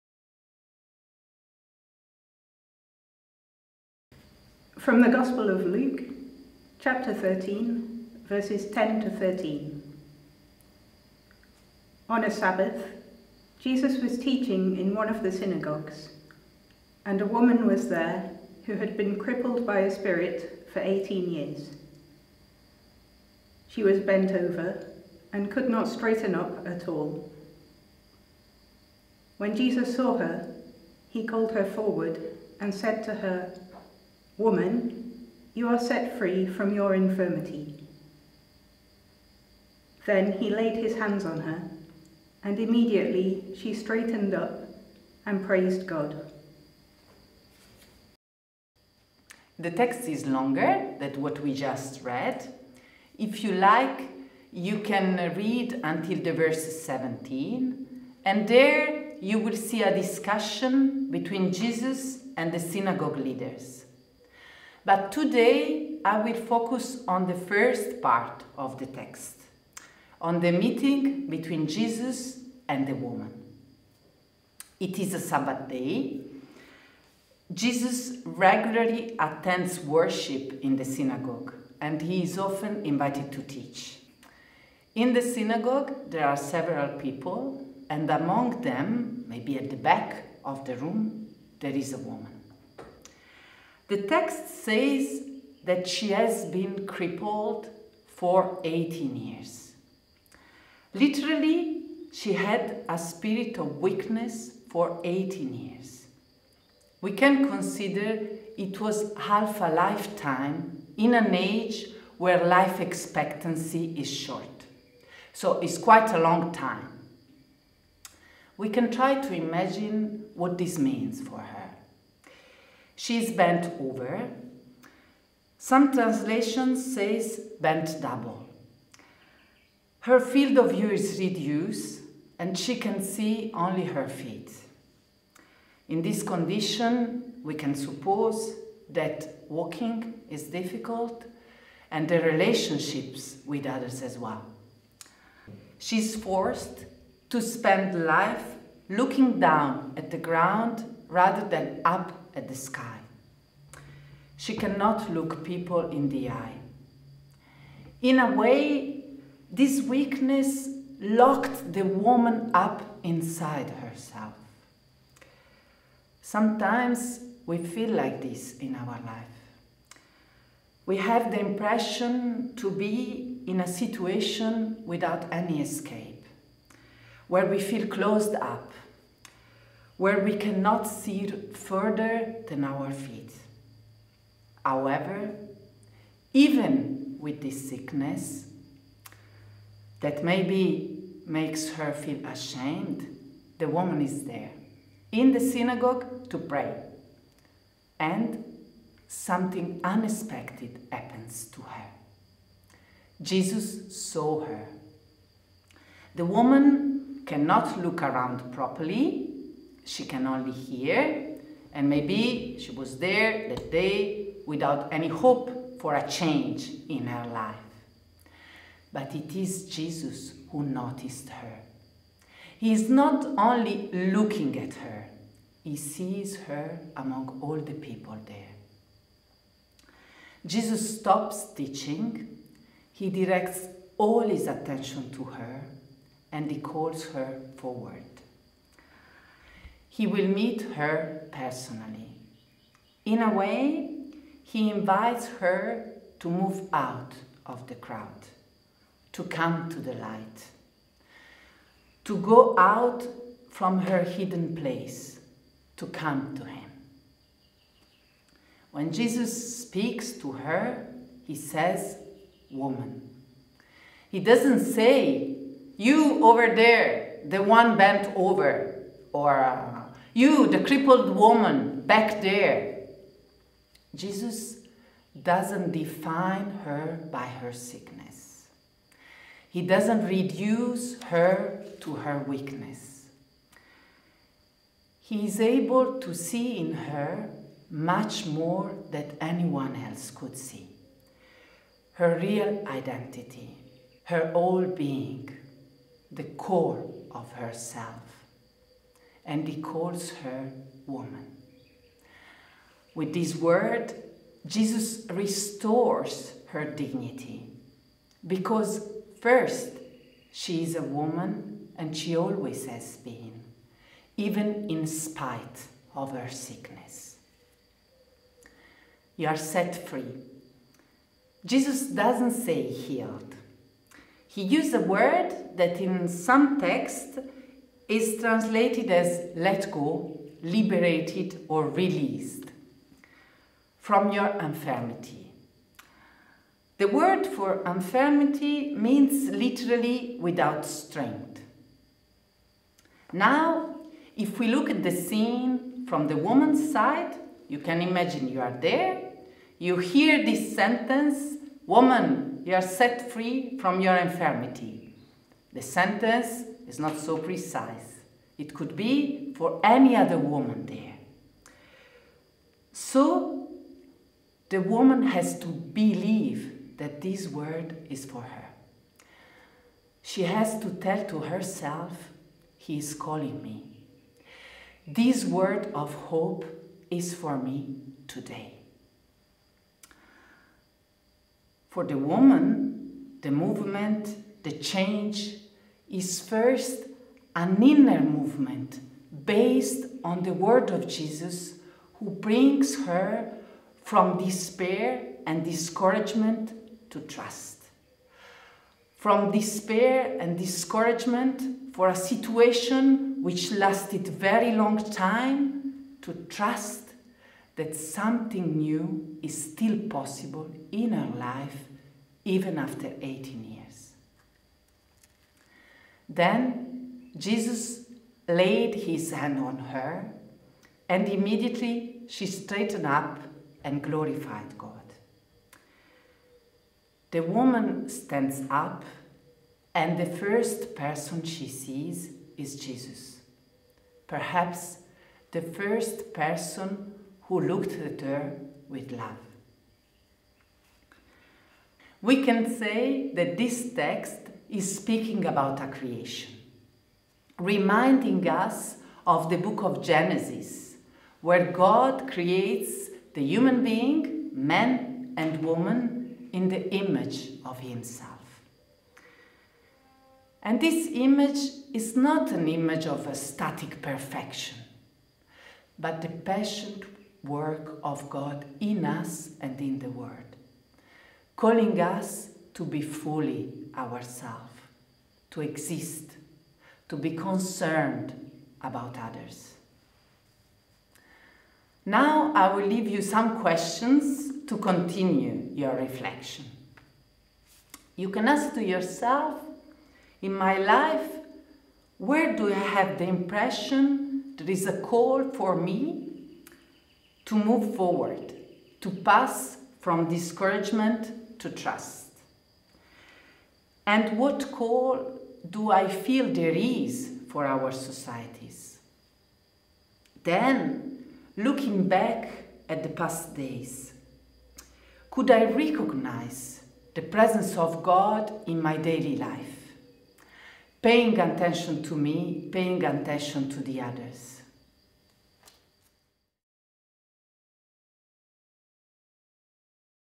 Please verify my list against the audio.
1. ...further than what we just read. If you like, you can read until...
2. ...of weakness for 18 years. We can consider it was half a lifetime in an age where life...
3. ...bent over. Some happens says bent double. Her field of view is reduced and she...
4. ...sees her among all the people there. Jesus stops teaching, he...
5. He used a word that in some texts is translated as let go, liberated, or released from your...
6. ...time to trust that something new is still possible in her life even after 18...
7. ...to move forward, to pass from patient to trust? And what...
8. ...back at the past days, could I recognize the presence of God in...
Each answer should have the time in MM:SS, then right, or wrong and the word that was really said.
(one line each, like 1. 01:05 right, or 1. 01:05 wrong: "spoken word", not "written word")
1. 00:50 wrong: "longer", not "further"
2. 01:43 right
3. 02:03 wrong: "translations", not "happens"
4. 03:45 right
5. 05:24 right
6. 06:44 right
7. 08:17 wrong: "discouragement", not "patient"
8. 08:31 right.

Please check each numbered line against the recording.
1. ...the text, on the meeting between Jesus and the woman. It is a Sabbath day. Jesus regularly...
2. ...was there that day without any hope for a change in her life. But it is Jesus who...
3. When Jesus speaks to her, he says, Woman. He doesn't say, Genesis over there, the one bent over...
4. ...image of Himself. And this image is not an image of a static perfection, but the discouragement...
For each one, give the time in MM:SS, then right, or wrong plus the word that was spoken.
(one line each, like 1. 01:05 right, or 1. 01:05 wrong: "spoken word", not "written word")
1. 01:08 right
2. 03:32 right
3. 04:18 wrong: "You", not "Genesis"
4. 07:36 wrong: "patient", not "discouragement".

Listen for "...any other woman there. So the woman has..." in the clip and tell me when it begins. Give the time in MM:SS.
05:59.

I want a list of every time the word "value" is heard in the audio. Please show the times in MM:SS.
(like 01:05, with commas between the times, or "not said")
not said.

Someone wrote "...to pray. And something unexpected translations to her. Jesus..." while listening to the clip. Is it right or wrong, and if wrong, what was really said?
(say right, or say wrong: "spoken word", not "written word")
wrong: "happens", not "translations".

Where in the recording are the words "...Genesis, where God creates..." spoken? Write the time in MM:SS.
07:29.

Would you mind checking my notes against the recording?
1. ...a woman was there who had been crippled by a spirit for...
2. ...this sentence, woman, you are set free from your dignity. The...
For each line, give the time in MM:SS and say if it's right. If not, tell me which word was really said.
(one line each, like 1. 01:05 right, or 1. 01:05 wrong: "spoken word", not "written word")
1. 00:17 right
2. 05:50 wrong: "infirmity", not "dignity".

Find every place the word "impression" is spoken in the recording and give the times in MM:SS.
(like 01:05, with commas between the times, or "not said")
02:51, 08:13.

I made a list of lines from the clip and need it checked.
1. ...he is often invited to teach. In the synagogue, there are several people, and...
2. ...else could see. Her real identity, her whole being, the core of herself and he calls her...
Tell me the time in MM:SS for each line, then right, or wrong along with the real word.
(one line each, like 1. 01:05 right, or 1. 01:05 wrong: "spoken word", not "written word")
1. 01:22 right
2. 04:49 right.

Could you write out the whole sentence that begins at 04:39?
He doesn't reduce her to her weakness.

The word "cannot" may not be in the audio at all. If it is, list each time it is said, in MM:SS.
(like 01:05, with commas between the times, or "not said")
02:34, 03:00, 03:27.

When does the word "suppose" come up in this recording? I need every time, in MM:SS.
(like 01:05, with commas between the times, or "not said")
02:17.